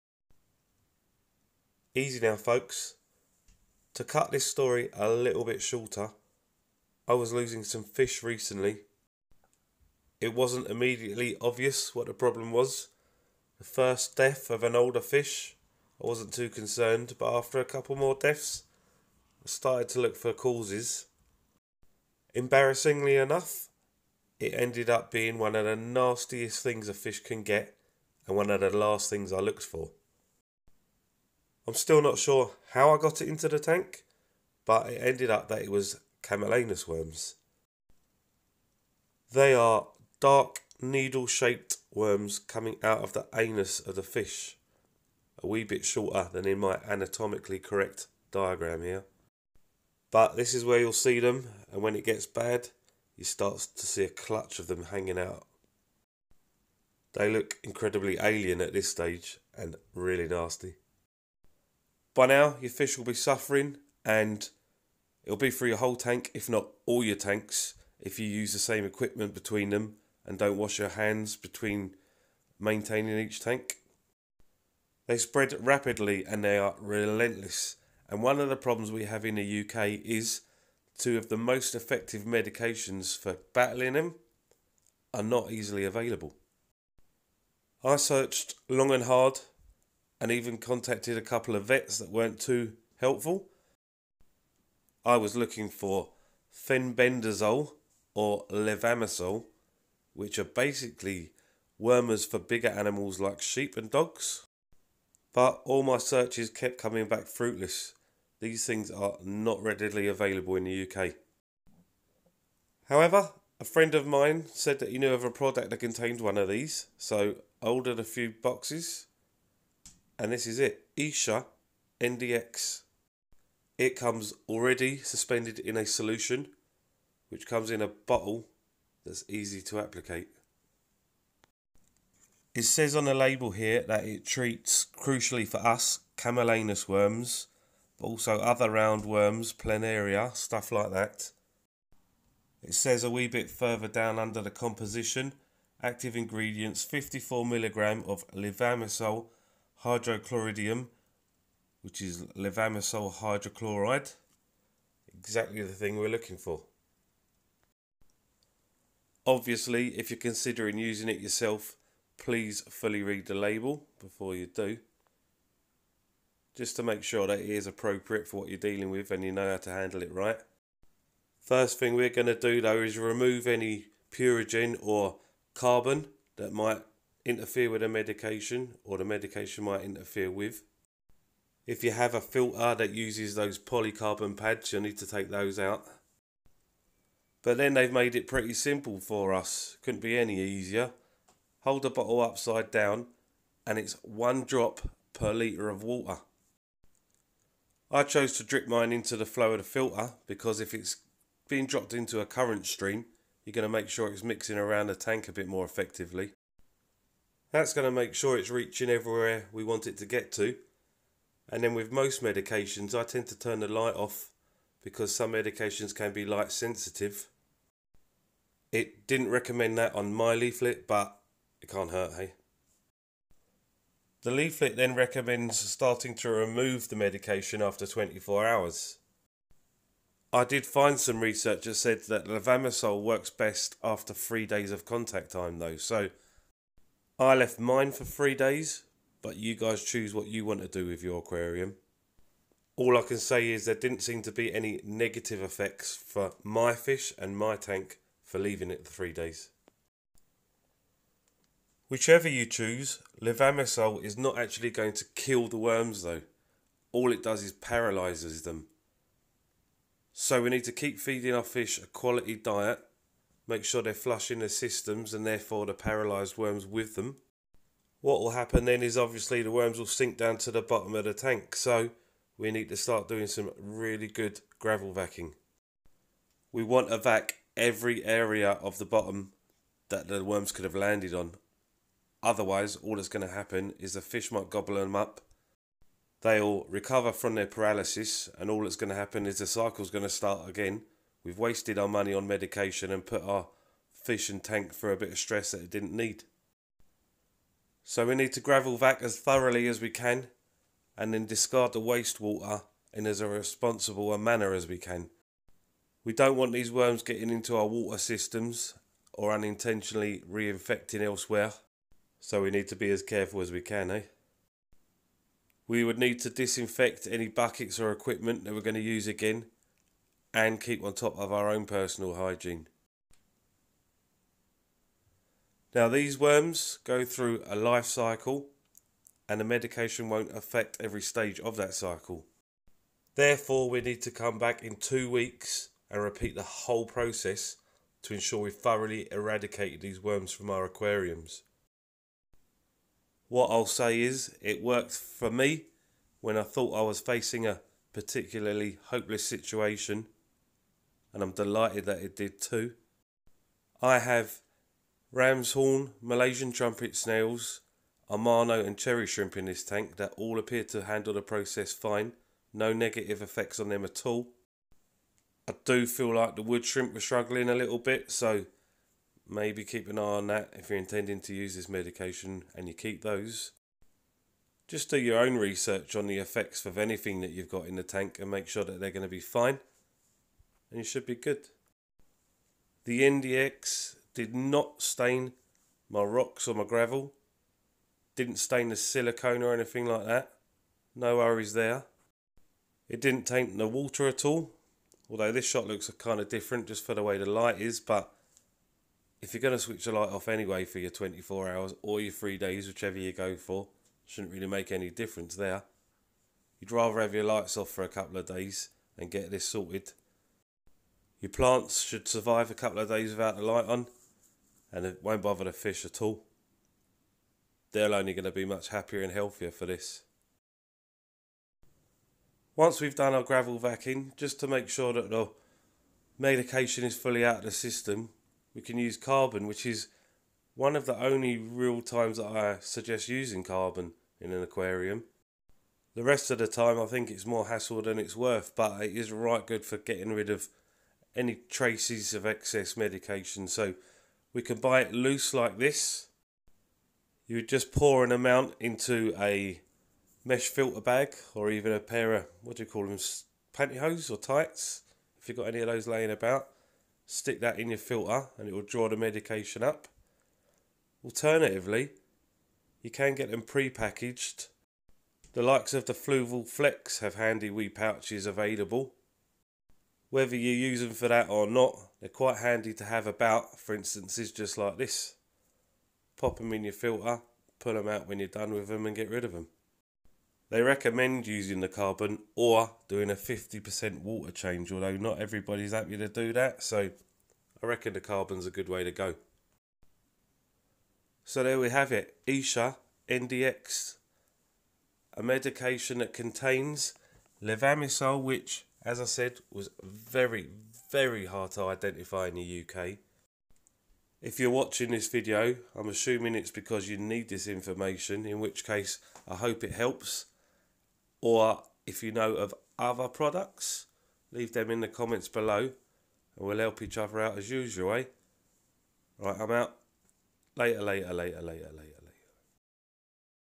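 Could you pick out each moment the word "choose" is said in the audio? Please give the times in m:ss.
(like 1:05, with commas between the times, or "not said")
3:59, 4:12.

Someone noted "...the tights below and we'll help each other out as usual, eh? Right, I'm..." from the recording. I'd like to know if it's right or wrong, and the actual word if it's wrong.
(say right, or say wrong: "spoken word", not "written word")
wrong: "comments", not "tights".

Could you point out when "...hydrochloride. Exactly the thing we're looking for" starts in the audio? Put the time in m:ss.
2:33.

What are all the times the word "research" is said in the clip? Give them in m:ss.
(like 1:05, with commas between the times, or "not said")
3:51, 6:15.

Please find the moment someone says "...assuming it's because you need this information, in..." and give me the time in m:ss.
8:25.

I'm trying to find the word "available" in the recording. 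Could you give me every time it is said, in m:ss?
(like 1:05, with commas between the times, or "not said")
1:25, 1:50, 7:48.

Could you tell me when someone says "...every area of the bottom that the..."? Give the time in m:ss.
4:37.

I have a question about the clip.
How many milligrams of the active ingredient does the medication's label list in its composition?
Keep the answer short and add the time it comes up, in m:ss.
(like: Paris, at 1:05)
54, at 2:26.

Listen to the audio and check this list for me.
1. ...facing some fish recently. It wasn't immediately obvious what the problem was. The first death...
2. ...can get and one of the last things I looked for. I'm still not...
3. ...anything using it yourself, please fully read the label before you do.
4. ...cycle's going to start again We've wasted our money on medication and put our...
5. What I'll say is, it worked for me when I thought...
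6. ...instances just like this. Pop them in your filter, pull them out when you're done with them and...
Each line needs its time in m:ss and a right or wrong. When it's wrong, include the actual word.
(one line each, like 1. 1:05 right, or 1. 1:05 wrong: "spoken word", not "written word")
1. 0:07 wrong: "losing", not "facing"
2. 0:27 right
3. 2:40 wrong: "considering", not "anything"
4. 4:49 right
5. 5:43 right
6. 7:53 right.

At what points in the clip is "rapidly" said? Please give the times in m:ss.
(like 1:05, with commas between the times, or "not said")
1:15.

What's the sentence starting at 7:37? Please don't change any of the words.
Stick that in your filter and it will draw the medication up.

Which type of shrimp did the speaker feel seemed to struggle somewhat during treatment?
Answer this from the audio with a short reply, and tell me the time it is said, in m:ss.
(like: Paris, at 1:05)
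wood shrimp, at 6:06.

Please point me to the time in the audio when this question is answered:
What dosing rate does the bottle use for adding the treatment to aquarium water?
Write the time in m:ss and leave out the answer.
3:14.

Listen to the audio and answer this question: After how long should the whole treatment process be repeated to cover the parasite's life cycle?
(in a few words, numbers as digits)
2 weeks.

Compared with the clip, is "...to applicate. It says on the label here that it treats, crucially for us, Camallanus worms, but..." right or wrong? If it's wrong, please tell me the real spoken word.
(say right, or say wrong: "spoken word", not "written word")
right.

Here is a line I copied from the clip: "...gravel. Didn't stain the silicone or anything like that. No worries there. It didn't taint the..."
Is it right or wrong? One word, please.
right.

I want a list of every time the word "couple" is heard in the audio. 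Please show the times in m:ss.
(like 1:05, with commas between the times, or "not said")
0:17, 1:31, 6:47, 6:52.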